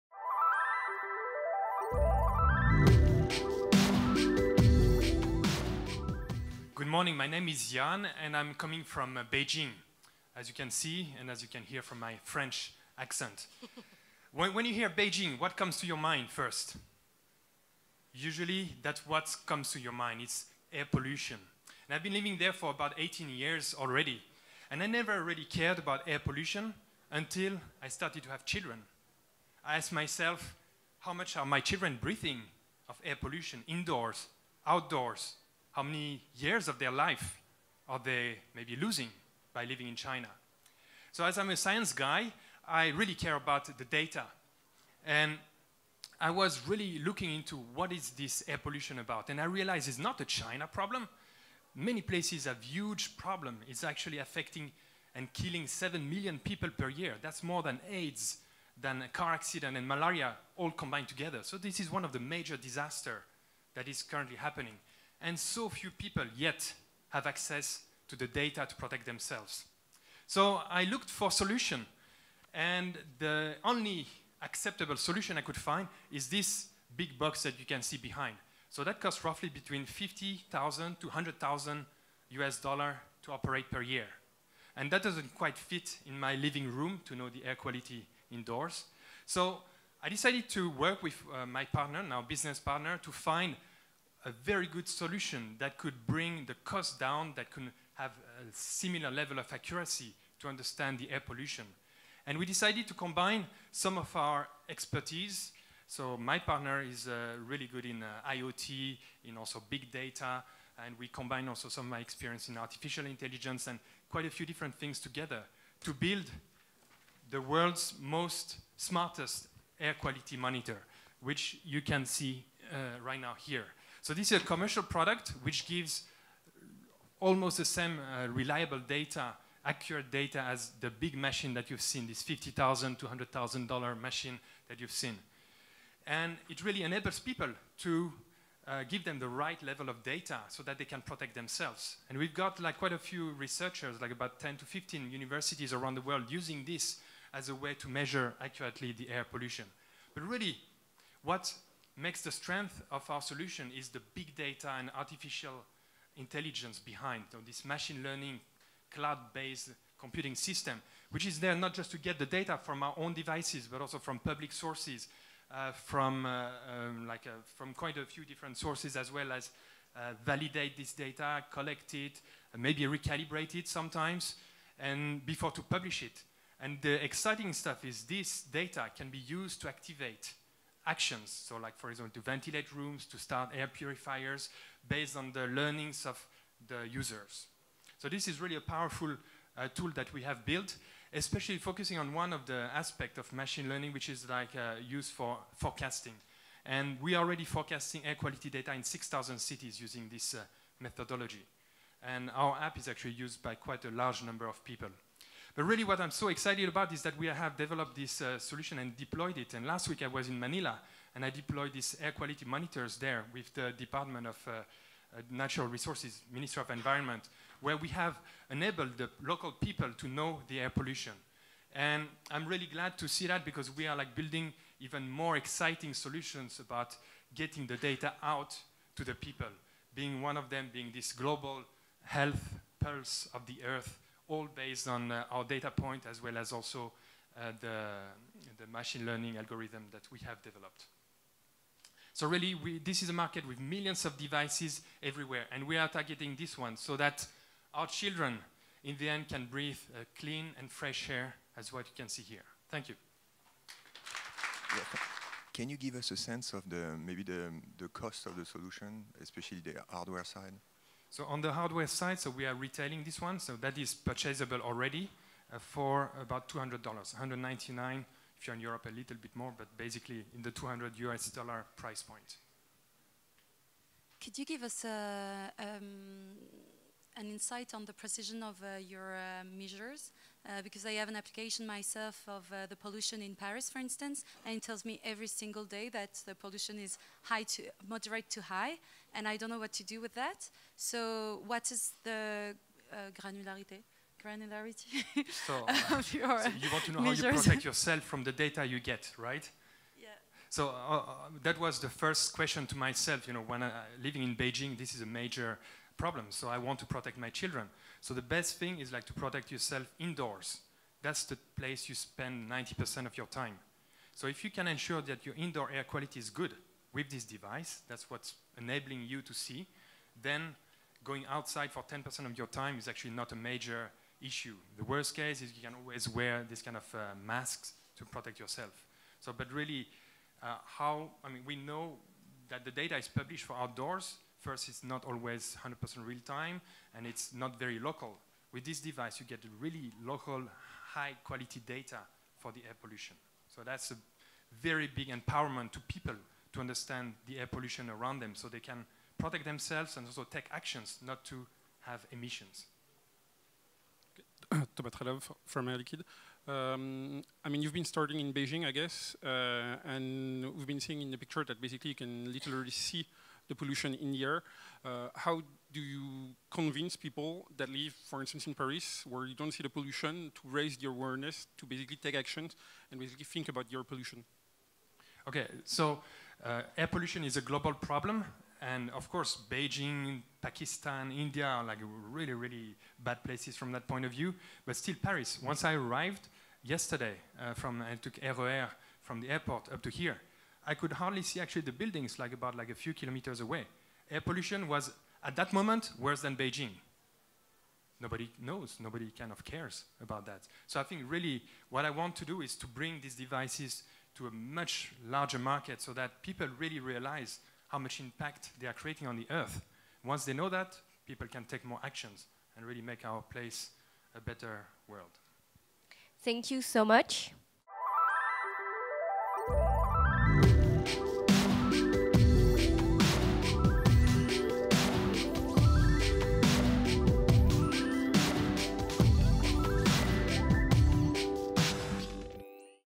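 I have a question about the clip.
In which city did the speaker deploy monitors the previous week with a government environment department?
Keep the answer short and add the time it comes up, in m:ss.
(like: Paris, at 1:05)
Manila, at 3:30.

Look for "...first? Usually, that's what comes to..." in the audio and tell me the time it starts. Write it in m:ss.
0:16.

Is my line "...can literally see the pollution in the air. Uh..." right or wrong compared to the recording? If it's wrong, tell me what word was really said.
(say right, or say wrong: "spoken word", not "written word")
right.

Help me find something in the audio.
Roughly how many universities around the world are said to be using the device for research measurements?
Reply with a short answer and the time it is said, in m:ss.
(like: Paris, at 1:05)
10 to 15, at 2:24.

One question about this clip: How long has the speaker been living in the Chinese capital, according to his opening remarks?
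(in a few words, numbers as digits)
18 years.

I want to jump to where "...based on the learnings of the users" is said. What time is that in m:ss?
3:04.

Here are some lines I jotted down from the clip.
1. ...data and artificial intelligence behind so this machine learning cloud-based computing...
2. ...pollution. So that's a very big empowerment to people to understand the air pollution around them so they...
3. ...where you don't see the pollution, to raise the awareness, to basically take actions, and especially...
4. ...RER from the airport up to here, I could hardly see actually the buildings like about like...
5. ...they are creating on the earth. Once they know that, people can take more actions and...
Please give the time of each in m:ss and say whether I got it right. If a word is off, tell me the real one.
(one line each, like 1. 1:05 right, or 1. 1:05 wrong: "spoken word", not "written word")
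1. 2:34 right
2. 5:42 right
3. 6:09 wrong: "basically", not "especially"
4. 6:28 right
5. 6:48 right.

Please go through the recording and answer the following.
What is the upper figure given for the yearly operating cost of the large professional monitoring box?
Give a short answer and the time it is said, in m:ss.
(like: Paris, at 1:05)
100,000 US dollars, at 1:21.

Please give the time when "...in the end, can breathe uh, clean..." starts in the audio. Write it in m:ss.
4:08.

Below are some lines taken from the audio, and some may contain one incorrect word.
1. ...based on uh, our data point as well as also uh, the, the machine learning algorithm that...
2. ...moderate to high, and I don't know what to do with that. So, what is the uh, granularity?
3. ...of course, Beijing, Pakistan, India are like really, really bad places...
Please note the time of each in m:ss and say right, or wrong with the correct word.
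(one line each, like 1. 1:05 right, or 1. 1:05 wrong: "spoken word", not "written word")
1. 3:54 right
2. 4:47 right
3. 6:18 right.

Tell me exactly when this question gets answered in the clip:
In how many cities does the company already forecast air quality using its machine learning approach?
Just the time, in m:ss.
3:18.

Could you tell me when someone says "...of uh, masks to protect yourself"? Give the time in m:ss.
5:26.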